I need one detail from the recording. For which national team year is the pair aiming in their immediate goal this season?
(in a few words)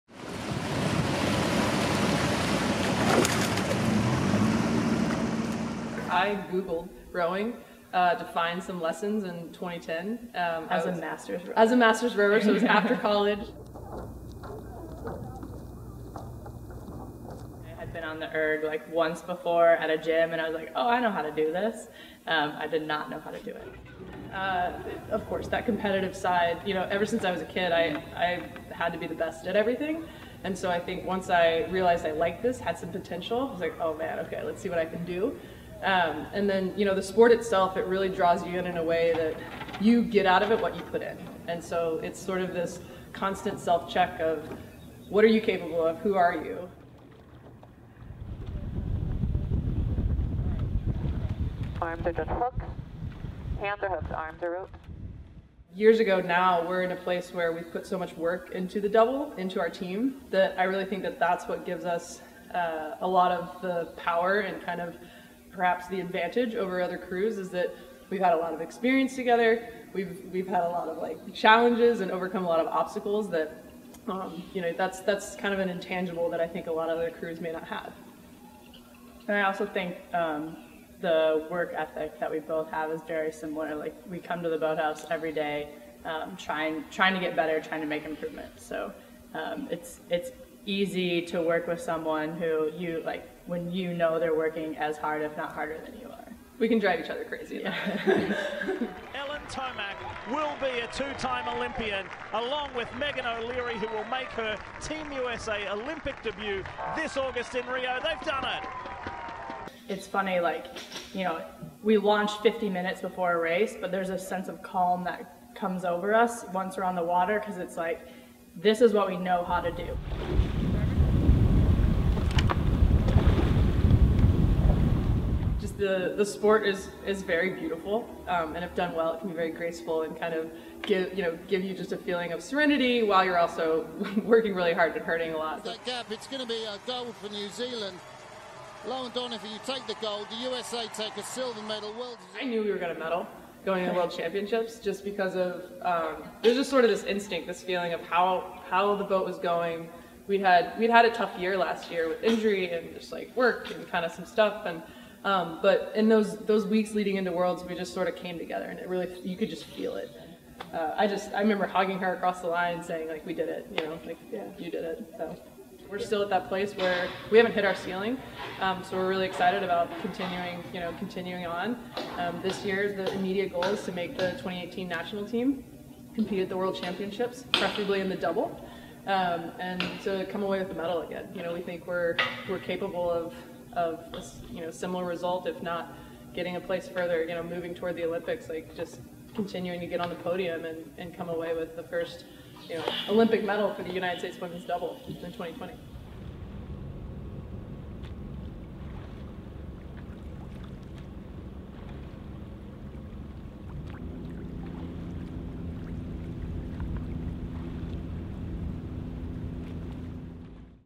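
2018.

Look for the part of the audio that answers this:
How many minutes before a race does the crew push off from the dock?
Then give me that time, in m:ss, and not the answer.
1:52.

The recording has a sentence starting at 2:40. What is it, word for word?
Uh, I just I remember hugging her across the line, saying like we did it, you know, like yeah.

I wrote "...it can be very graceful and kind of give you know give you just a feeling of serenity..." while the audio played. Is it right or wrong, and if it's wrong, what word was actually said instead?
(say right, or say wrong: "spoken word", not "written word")
right.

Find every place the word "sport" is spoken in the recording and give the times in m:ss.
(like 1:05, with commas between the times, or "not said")
0:37, 2:06.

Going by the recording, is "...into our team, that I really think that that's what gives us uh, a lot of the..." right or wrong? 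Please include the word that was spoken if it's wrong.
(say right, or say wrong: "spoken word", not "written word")
right.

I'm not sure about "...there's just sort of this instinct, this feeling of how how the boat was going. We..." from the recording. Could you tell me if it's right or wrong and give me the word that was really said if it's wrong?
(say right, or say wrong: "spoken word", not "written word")
right.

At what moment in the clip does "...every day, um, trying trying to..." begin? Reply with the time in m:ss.
1:25.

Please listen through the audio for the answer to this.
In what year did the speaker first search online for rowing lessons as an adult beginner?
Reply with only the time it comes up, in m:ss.
0:09.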